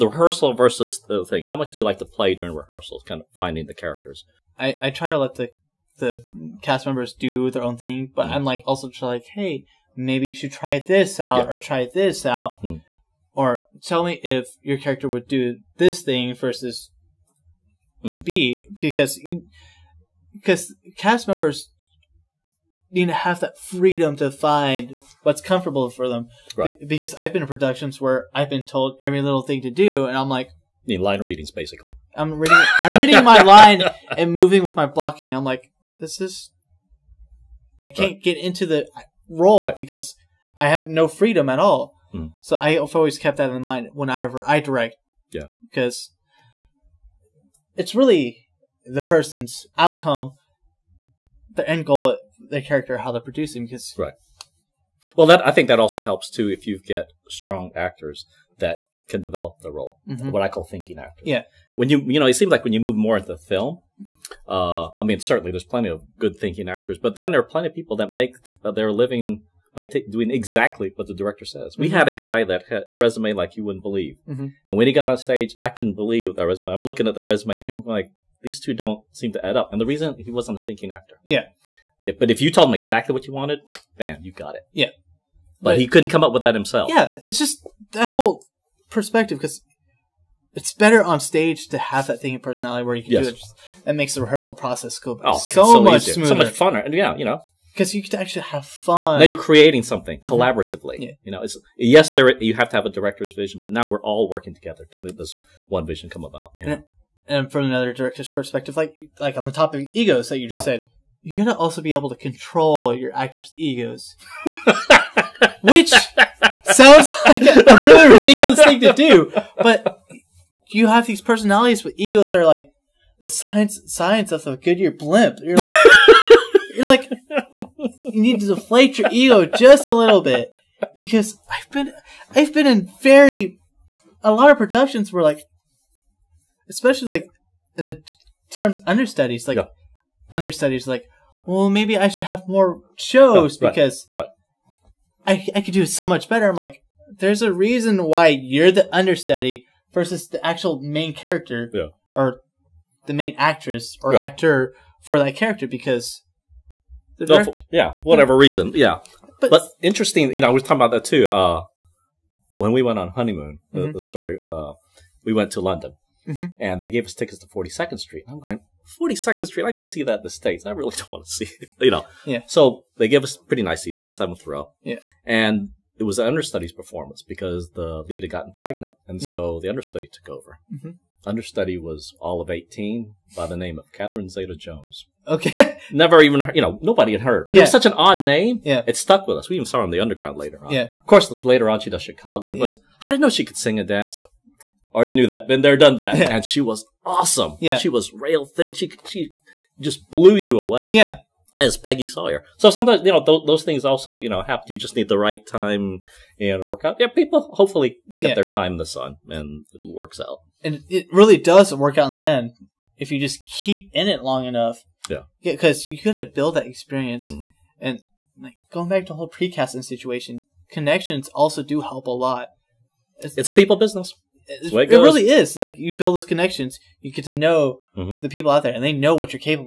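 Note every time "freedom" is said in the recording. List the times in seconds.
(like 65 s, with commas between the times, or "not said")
23 s, 41 s.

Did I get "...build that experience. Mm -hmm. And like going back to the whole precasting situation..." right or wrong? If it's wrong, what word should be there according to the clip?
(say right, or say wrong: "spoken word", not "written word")
right.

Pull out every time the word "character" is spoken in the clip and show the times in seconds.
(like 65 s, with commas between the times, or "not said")
3 s, 14 s, 52 s, 151 s, 155 s.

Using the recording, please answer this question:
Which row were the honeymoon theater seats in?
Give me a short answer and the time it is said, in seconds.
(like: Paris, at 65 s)
7th row, at 174 s.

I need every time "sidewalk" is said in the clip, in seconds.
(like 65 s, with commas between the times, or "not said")
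not said.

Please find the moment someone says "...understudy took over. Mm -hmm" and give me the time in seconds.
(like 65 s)
179 s.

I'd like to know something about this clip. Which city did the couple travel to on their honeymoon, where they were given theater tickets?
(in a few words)
London.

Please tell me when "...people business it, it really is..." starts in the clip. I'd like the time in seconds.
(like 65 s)
223 s.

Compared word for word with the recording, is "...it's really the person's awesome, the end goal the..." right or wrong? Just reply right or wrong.
wrong.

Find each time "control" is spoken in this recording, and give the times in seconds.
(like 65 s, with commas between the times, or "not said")
112 s.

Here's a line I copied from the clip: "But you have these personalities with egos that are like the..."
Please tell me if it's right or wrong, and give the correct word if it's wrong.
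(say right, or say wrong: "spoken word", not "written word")
right.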